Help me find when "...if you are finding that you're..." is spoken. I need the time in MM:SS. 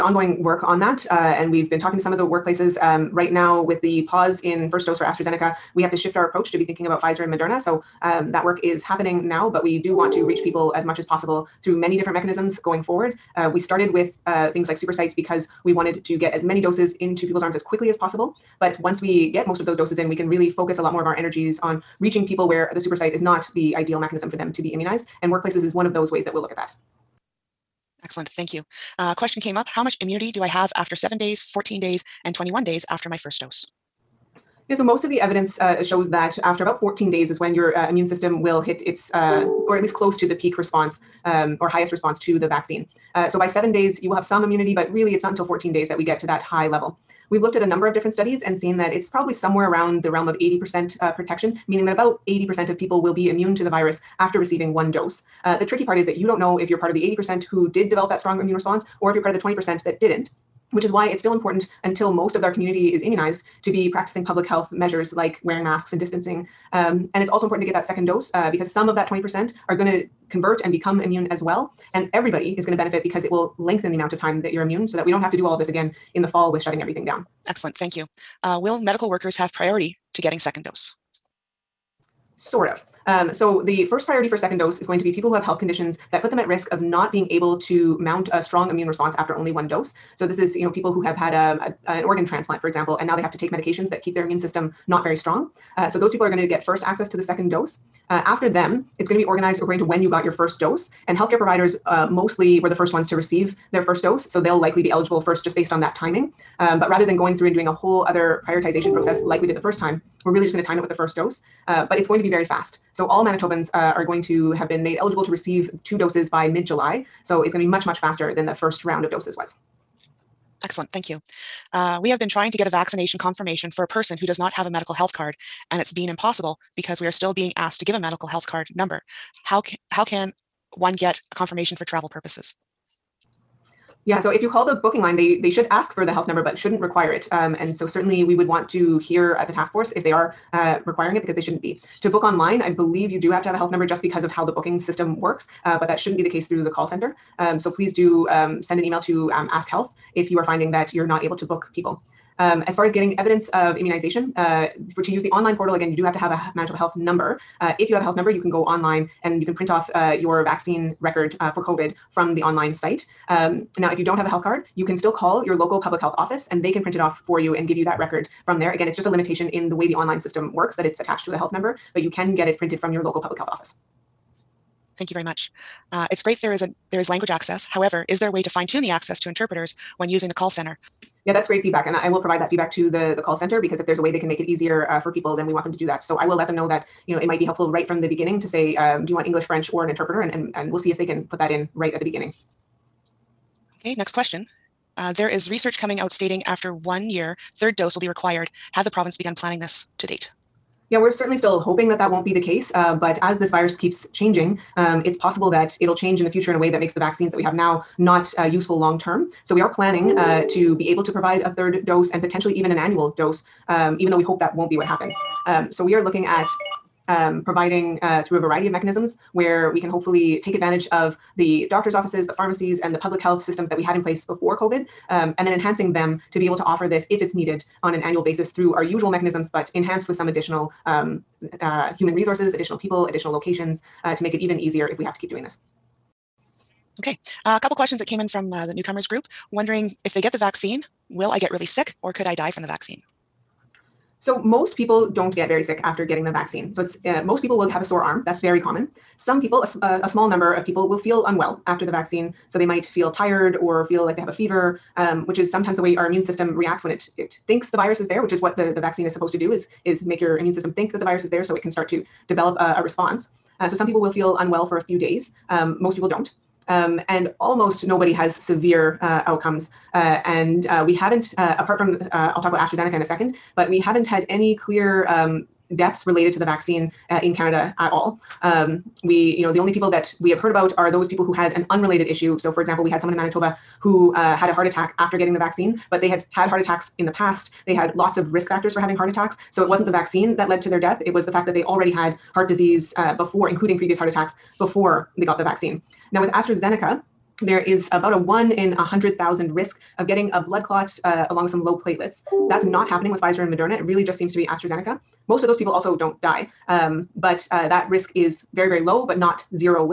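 02:30.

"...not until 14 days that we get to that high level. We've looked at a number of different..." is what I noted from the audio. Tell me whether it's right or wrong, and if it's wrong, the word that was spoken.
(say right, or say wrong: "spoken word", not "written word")
right.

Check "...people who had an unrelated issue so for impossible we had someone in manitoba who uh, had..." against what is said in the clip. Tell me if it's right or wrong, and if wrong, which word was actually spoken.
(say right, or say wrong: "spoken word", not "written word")
wrong: "example", not "impossible".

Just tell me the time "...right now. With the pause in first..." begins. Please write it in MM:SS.
00:03.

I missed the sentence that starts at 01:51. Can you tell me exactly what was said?
Uh, but it's going to be very fast.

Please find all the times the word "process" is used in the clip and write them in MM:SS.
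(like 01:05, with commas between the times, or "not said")
01:48.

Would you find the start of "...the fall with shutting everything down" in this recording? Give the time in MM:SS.
01:16.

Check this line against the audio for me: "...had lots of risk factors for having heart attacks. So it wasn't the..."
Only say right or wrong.
right.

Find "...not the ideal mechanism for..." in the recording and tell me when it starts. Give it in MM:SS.
00:23.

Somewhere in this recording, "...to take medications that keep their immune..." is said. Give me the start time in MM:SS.
01:33.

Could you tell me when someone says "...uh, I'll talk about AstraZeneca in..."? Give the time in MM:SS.
04:32.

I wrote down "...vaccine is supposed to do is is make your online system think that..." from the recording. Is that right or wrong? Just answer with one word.
wrong.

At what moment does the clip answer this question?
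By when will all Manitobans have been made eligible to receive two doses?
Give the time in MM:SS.
01:56.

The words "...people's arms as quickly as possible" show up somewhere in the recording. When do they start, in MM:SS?
00:17.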